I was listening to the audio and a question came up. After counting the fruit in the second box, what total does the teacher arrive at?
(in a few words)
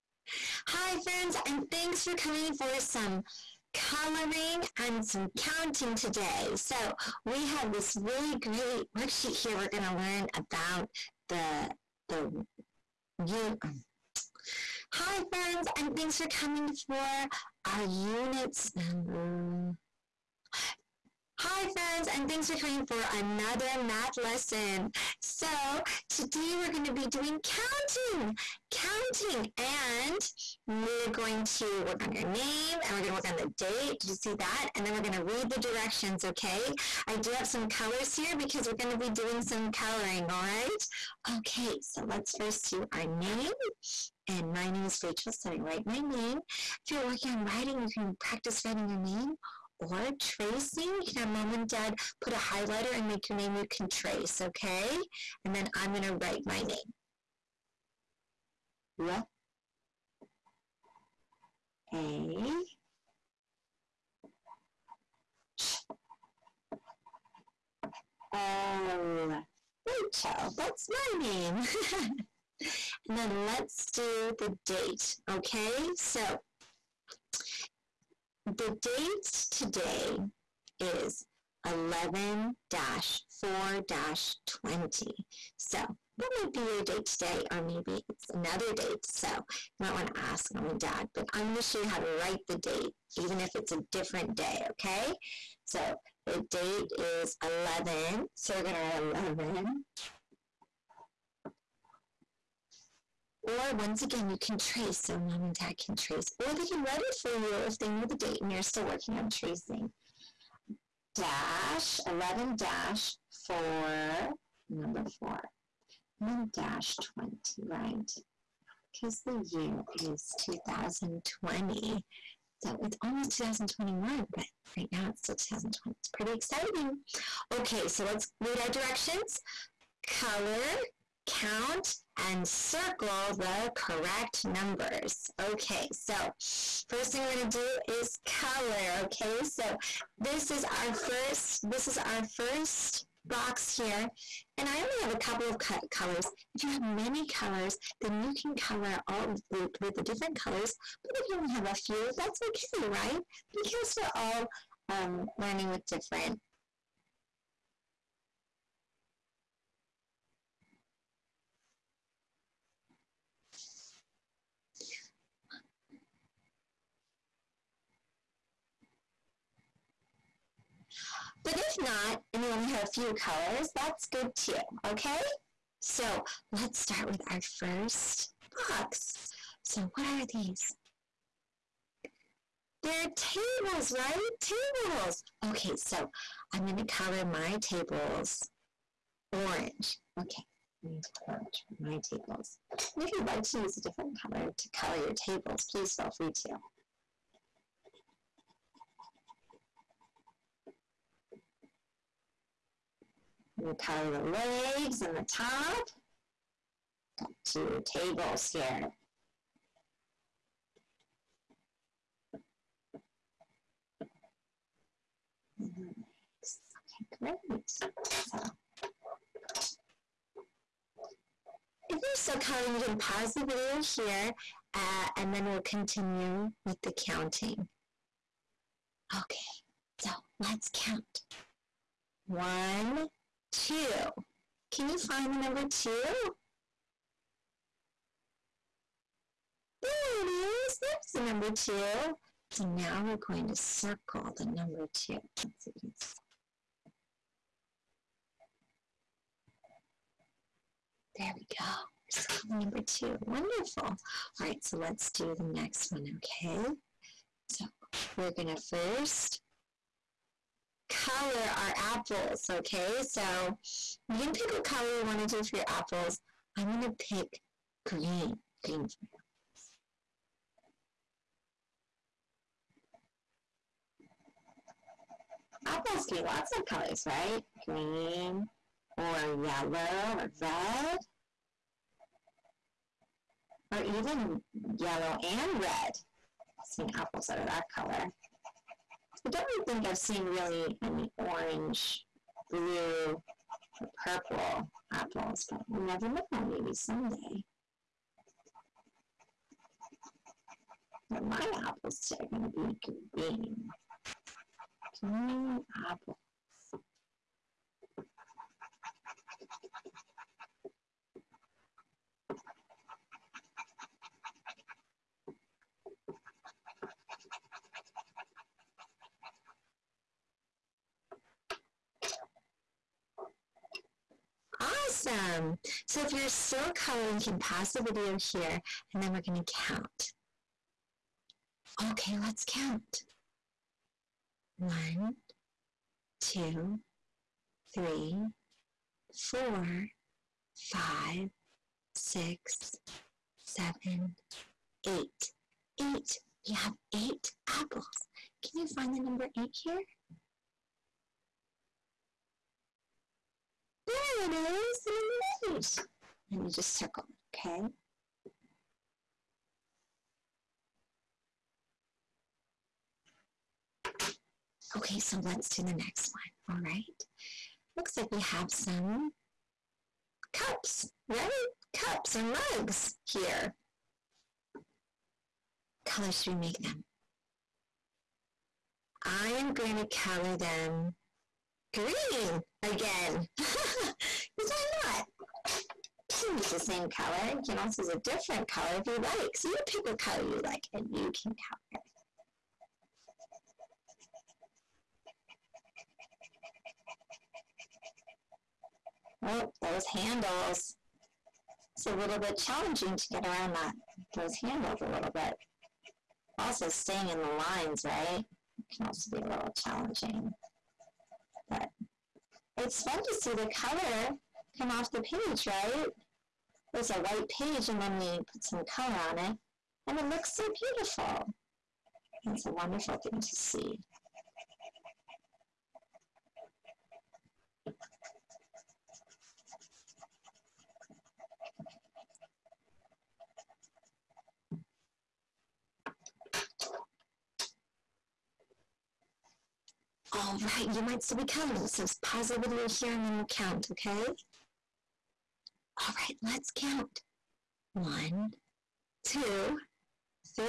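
8.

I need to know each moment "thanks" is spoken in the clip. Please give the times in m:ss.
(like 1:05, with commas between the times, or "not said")
0:01, 0:15, 0:22.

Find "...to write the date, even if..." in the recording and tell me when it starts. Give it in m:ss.
1:31.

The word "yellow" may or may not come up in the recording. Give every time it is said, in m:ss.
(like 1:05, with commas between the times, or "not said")
4:39, 4:44.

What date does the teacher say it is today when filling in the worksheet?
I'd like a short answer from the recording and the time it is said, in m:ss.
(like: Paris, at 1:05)
11 4 20, at 1:21.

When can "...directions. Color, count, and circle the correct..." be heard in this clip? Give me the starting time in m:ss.
2:08.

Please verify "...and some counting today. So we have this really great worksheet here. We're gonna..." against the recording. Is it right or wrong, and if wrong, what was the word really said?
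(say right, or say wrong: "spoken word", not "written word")
right.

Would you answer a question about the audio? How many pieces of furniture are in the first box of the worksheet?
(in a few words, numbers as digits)
2.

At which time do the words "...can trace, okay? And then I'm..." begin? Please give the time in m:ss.
0:53.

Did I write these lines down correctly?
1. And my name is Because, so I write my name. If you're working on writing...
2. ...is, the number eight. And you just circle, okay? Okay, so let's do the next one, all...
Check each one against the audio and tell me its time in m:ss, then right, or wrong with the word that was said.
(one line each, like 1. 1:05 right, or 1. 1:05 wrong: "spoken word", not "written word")
1. 0:44 wrong: "Rachel", not "Because"
2. 5:54 right.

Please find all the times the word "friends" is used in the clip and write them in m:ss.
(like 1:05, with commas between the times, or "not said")
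0:00, 0:15, 0:21.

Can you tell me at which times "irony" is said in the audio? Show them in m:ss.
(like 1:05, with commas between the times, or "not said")
not said.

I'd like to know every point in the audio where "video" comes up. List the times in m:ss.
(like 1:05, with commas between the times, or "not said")
3:43, 5:27, 7:22.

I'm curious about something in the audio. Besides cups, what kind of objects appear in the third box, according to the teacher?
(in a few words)
mugs.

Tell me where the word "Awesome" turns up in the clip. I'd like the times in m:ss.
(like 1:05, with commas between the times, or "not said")
5:25.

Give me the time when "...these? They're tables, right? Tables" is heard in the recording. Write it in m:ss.
3:00.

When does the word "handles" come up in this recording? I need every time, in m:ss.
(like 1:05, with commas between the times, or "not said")
6:39, 6:44.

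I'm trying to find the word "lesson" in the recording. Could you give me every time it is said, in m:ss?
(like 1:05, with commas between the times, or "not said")
0:24.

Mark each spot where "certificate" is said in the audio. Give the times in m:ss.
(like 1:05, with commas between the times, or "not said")
not said.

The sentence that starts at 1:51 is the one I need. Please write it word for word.
Dash, 11 dash 4, number 4.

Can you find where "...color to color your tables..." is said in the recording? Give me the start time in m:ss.
3:14.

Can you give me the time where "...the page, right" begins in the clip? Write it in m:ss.
6:54.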